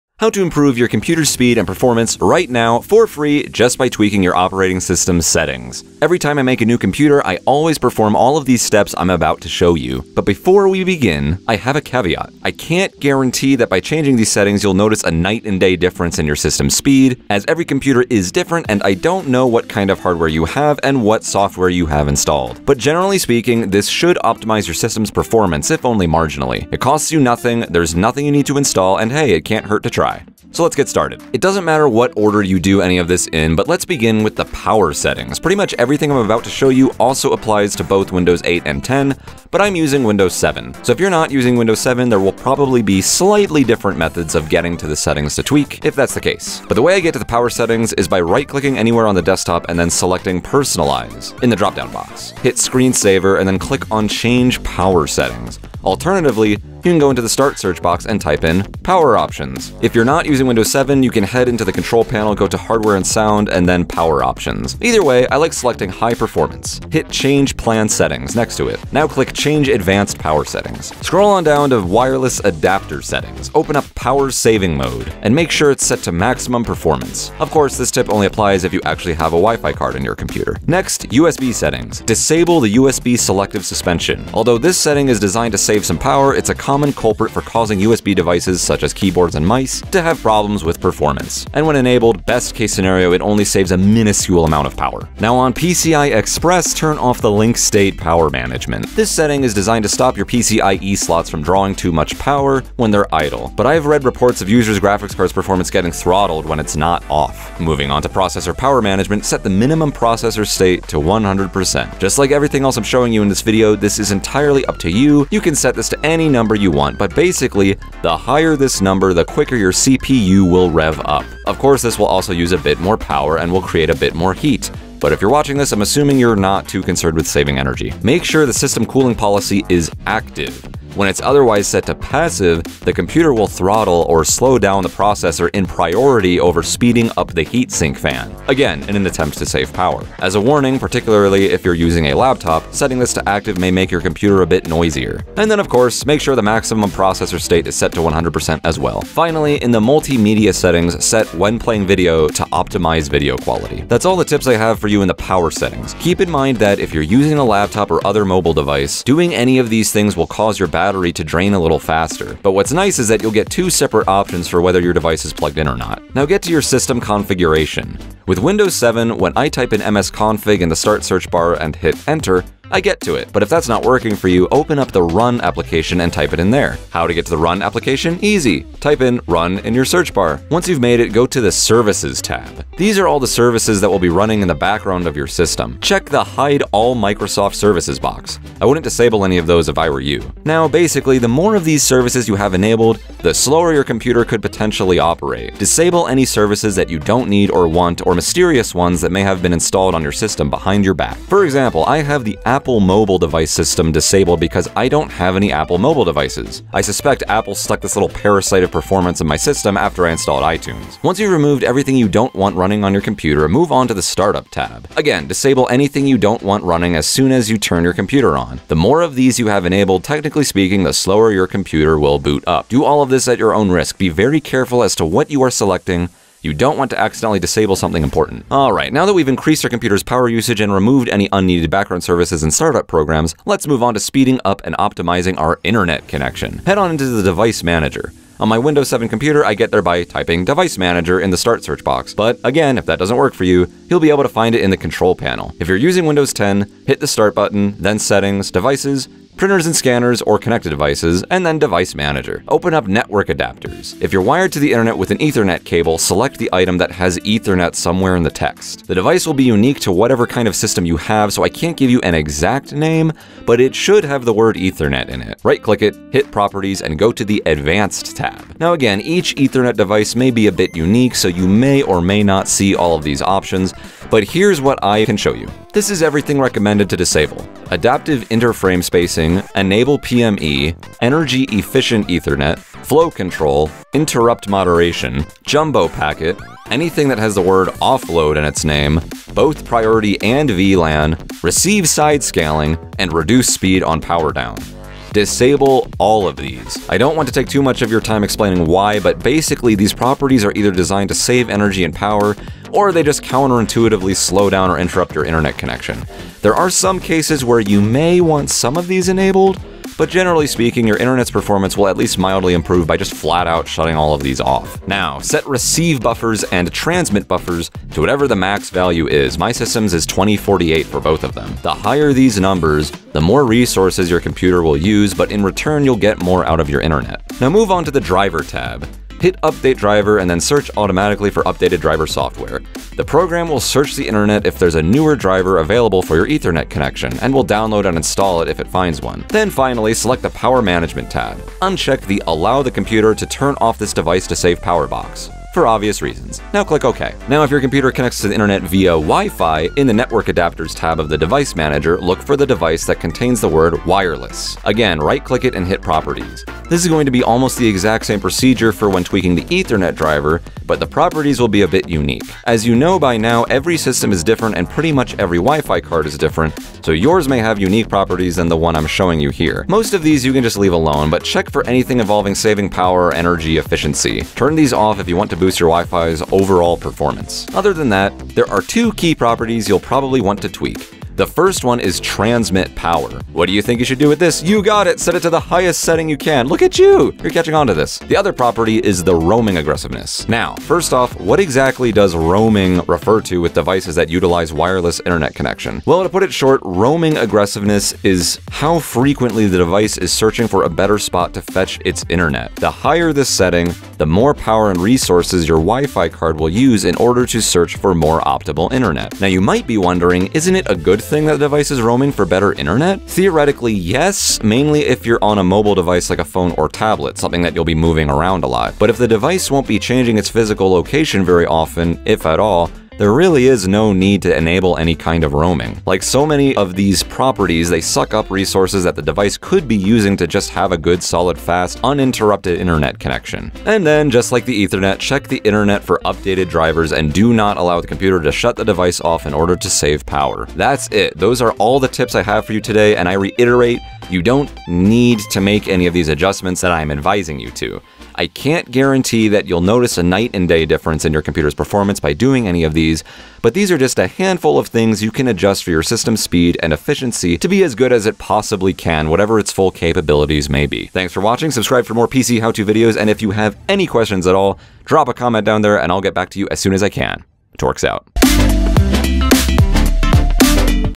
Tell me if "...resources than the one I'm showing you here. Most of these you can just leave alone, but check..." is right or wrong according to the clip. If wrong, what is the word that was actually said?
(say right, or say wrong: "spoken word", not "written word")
wrong: "properties", not "resources".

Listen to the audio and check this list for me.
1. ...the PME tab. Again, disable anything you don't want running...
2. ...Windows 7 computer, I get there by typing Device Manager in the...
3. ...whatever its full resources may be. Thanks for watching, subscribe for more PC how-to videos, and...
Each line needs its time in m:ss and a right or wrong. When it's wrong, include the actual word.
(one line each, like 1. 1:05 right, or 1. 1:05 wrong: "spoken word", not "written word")
1. 3:33 wrong: "Startup", not "PME"
2. 3:58 right
3. 7:39 wrong: "capabilities", not "resources".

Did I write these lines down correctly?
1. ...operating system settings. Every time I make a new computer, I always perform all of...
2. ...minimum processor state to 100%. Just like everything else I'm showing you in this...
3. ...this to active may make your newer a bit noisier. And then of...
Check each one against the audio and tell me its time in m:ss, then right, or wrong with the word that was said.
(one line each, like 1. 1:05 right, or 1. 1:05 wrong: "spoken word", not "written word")
1. 0:04 right
2. 1:49 right
3. 2:22 wrong: "computer", not "newer".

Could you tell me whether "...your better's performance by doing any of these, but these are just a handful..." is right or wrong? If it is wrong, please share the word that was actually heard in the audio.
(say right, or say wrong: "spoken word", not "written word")
wrong: "computer", not "better".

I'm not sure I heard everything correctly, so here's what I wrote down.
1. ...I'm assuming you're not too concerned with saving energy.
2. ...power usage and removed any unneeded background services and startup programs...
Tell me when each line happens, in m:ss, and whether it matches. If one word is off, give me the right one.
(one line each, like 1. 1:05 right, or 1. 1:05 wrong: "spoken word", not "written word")
1. 2:05 right
2. 3:50 right.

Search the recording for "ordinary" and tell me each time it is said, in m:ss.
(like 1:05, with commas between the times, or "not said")
not said.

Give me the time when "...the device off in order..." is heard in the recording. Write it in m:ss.
7:18.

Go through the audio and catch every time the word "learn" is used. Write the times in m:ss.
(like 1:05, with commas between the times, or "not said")
not said.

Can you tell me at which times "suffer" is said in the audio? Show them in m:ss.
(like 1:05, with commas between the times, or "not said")
not said.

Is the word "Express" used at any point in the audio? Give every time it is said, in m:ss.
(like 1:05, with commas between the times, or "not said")
1:36.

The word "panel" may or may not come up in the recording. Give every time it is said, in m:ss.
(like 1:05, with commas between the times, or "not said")
1:02, 4:05.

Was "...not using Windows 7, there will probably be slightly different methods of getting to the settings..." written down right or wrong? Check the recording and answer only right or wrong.
right.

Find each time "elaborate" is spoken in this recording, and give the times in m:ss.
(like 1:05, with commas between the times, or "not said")
not said.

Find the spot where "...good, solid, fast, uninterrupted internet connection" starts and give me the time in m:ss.
7:10.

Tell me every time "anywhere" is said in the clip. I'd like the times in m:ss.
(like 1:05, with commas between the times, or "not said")
0:48.